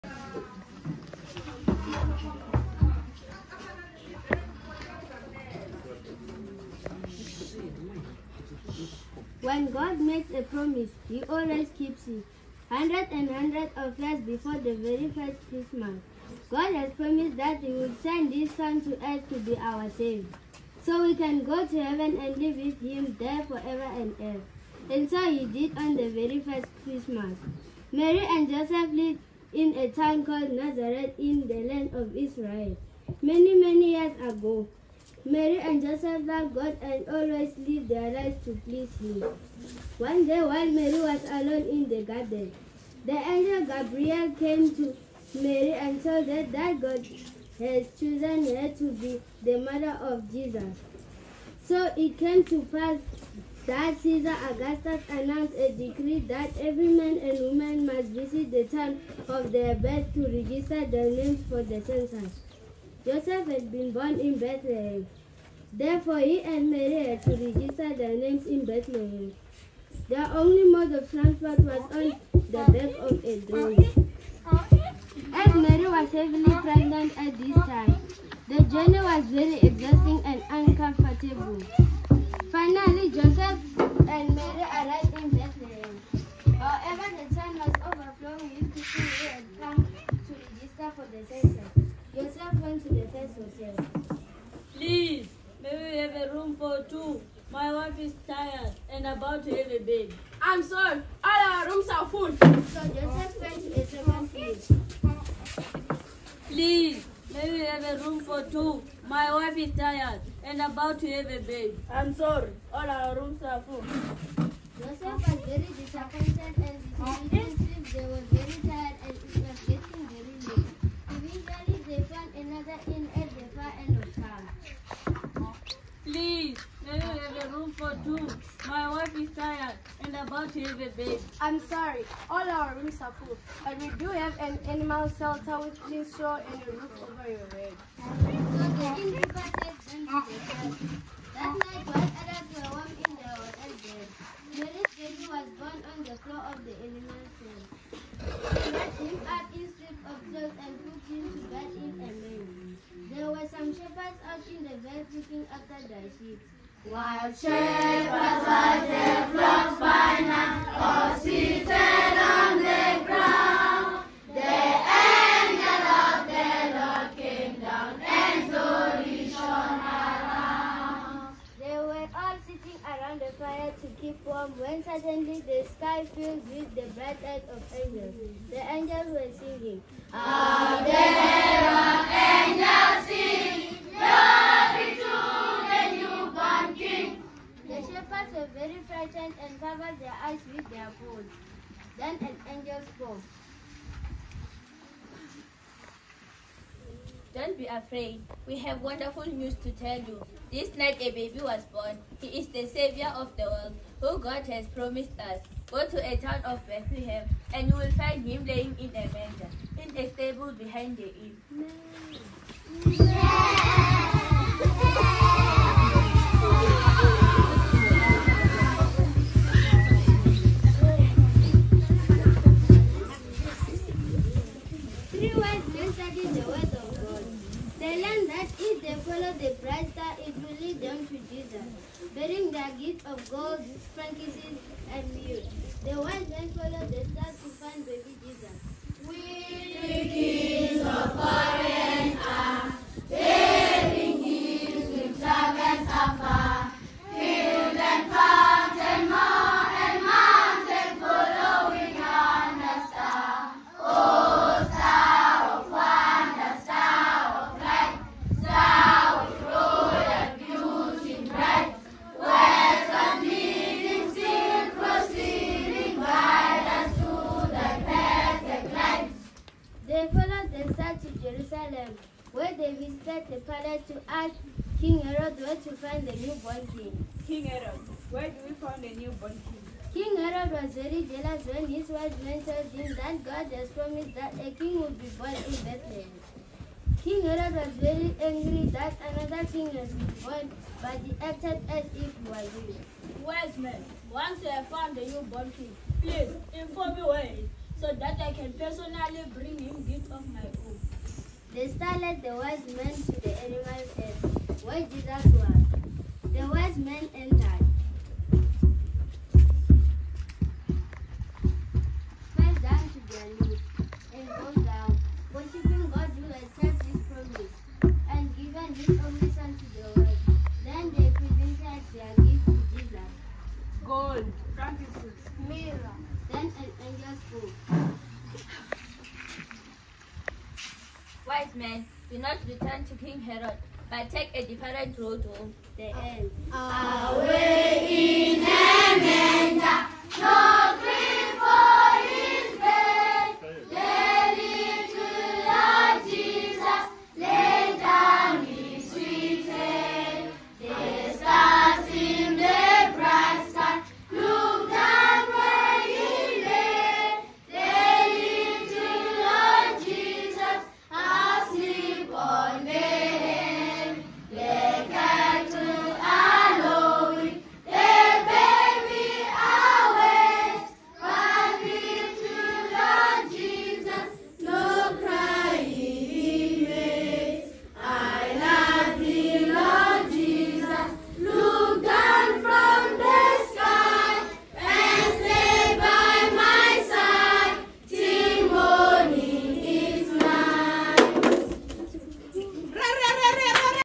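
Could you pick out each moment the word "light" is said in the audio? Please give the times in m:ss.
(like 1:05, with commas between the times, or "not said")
2:57.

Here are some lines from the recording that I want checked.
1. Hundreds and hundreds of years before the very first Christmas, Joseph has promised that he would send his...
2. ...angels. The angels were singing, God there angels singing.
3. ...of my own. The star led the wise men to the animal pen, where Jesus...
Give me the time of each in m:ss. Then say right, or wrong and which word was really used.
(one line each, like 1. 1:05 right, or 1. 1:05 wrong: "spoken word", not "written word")
1. 0:12 wrong: "God", not "Joseph"
2. 2:57 wrong: "How", not "God"
3. 5:00 right.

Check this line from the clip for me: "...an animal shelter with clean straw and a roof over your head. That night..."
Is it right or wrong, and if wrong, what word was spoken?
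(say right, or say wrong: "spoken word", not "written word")
right.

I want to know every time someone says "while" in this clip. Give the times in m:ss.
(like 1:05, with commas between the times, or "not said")
0:40, 2:21, 2:36.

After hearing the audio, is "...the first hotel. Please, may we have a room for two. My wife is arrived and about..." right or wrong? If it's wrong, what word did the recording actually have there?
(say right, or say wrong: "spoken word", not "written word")
wrong: "tired", not "arrived".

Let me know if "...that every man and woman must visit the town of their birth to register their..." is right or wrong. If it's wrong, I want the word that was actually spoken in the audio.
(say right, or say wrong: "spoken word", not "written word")
right.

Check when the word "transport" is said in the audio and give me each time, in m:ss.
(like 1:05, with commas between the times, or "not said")
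1:11.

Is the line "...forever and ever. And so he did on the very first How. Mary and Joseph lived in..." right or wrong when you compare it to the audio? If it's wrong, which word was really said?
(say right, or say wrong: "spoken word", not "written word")
wrong: "Christmas", not "How".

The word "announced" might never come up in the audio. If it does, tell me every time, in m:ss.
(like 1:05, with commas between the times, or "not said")
0:55.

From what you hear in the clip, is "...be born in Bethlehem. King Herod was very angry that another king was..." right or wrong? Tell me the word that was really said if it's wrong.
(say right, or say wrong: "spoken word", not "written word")
right.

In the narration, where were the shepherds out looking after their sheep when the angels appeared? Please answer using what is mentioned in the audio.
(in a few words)
the veld.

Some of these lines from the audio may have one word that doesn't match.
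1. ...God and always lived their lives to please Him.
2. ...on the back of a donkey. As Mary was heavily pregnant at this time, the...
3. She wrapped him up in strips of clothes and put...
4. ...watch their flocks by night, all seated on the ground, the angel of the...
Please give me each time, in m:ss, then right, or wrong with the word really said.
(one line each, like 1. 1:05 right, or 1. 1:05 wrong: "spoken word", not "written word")
1. 0:36 right
2. 1:11 right
3. 2:28 right
4. 2:38 right.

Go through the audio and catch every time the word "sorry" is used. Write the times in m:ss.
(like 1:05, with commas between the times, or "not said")
1:40, 1:52, 2:11.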